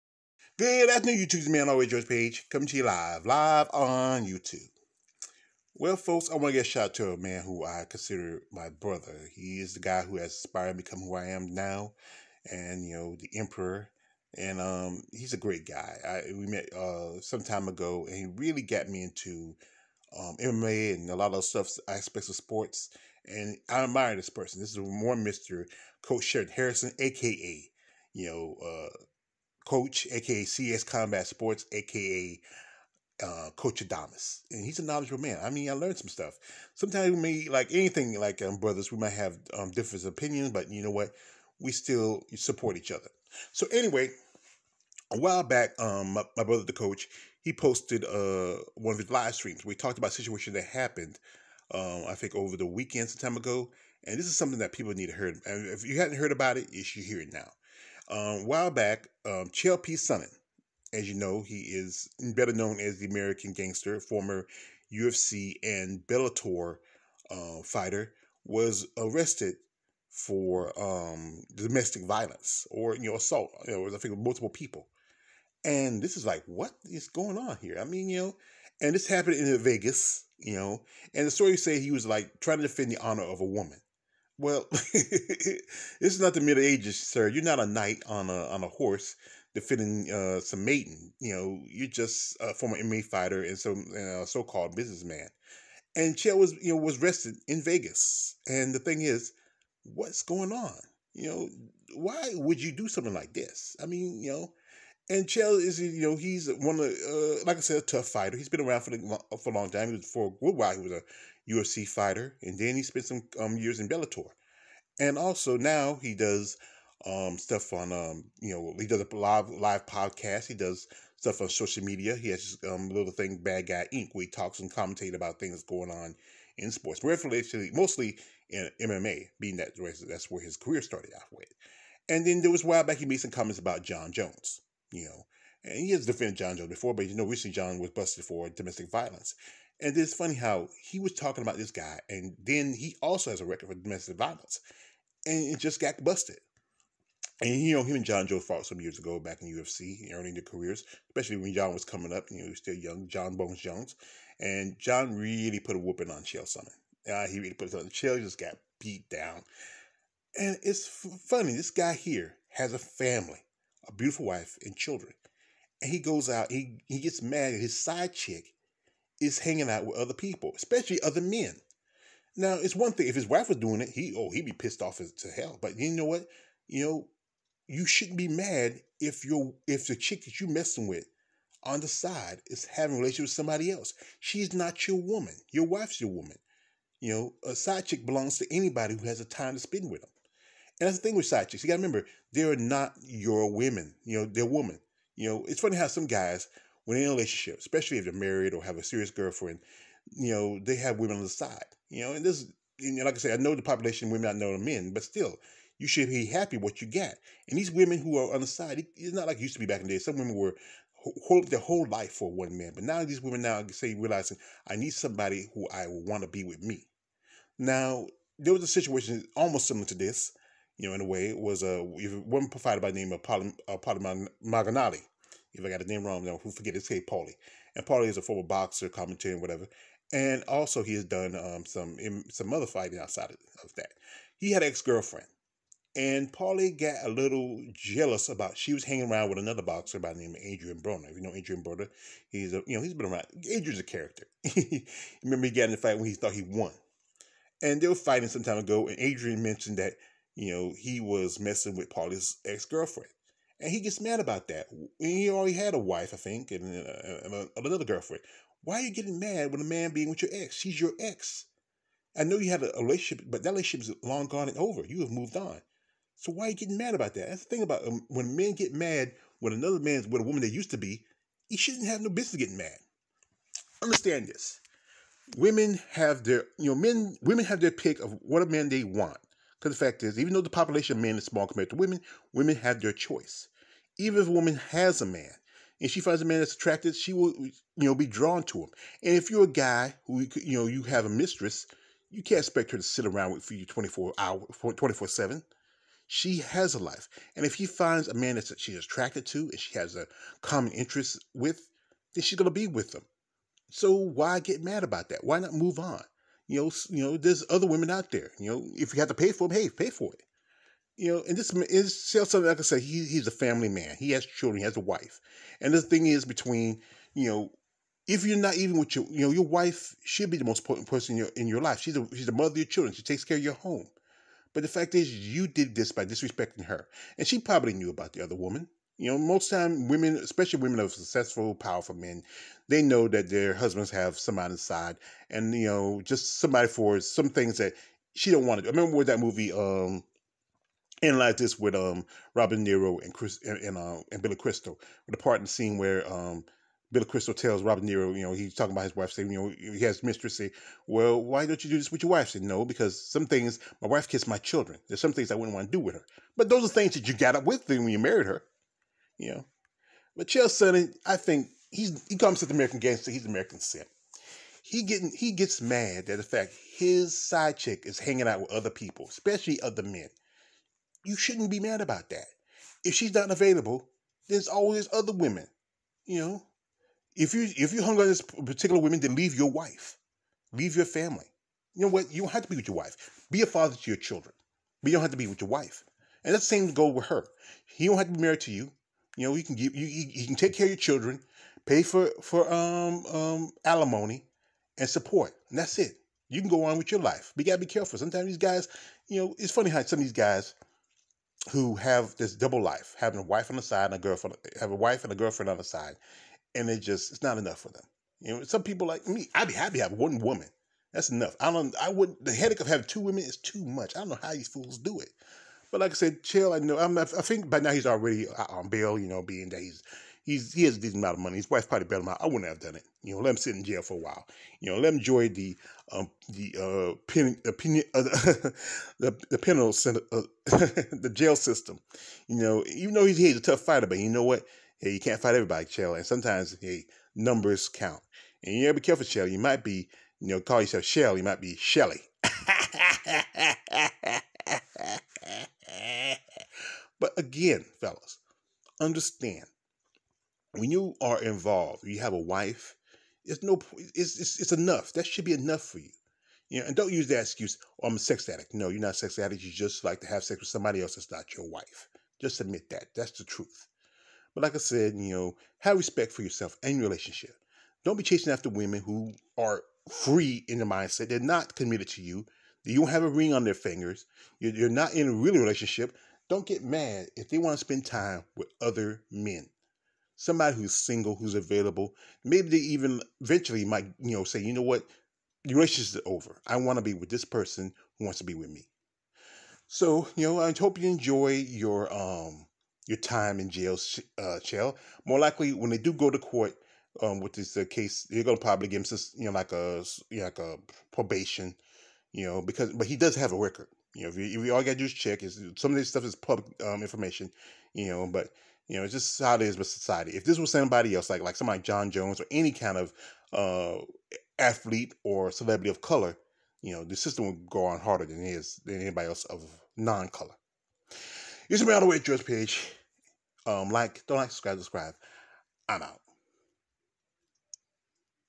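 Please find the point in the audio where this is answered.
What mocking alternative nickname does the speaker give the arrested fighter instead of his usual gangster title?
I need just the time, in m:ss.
6:03.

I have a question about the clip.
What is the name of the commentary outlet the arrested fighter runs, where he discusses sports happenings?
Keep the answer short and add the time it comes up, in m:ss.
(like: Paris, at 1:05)
Bad Guy Inc., at 2:03.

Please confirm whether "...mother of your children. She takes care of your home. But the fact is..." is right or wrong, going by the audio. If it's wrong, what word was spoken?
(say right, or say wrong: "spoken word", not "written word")
right.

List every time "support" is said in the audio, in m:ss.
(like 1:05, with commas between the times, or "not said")
0:42, 6:34.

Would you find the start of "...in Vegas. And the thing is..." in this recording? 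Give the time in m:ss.
1:37.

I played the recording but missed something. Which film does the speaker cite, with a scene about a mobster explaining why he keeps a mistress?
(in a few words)
Analyze This.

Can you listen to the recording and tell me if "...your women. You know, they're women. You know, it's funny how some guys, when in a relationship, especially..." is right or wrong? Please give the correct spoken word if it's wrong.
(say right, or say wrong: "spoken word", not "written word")
right.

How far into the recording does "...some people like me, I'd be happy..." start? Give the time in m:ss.
6:48.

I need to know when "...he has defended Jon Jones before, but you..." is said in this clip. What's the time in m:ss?
2:15.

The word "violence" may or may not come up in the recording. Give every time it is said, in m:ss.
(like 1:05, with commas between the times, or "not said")
1:12, 2:18, 2:24.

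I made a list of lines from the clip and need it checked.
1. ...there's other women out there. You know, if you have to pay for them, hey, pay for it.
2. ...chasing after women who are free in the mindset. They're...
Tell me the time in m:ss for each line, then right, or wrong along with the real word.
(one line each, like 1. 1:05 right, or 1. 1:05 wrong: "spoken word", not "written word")
1. 5:07 right
2. 7:48 right.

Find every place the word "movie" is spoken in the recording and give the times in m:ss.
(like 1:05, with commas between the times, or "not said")
5:39.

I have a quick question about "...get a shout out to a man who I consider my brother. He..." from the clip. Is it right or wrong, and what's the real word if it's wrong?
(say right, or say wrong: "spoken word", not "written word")
right.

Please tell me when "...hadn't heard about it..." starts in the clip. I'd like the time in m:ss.
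0:55.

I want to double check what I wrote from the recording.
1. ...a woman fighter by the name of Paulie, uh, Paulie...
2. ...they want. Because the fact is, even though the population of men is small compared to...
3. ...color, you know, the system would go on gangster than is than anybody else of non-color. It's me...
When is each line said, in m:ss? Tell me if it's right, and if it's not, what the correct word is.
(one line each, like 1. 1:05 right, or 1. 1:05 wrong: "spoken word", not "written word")
1. 3:41 right
2. 4:38 right
3. 8:35 wrong: "harder", not "gangster".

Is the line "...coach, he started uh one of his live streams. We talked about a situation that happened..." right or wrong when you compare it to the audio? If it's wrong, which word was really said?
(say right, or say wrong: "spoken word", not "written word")
wrong: "posted", not "started".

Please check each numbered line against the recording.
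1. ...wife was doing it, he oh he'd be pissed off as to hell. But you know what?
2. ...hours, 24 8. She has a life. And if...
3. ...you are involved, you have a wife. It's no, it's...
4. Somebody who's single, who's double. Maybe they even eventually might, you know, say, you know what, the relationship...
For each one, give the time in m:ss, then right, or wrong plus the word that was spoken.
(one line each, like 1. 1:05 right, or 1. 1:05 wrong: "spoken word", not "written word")
1. 2:53 right
2. 4:54 wrong: "7", not "8"
3. 7:30 right
4. 8:00 wrong: "available", not "double".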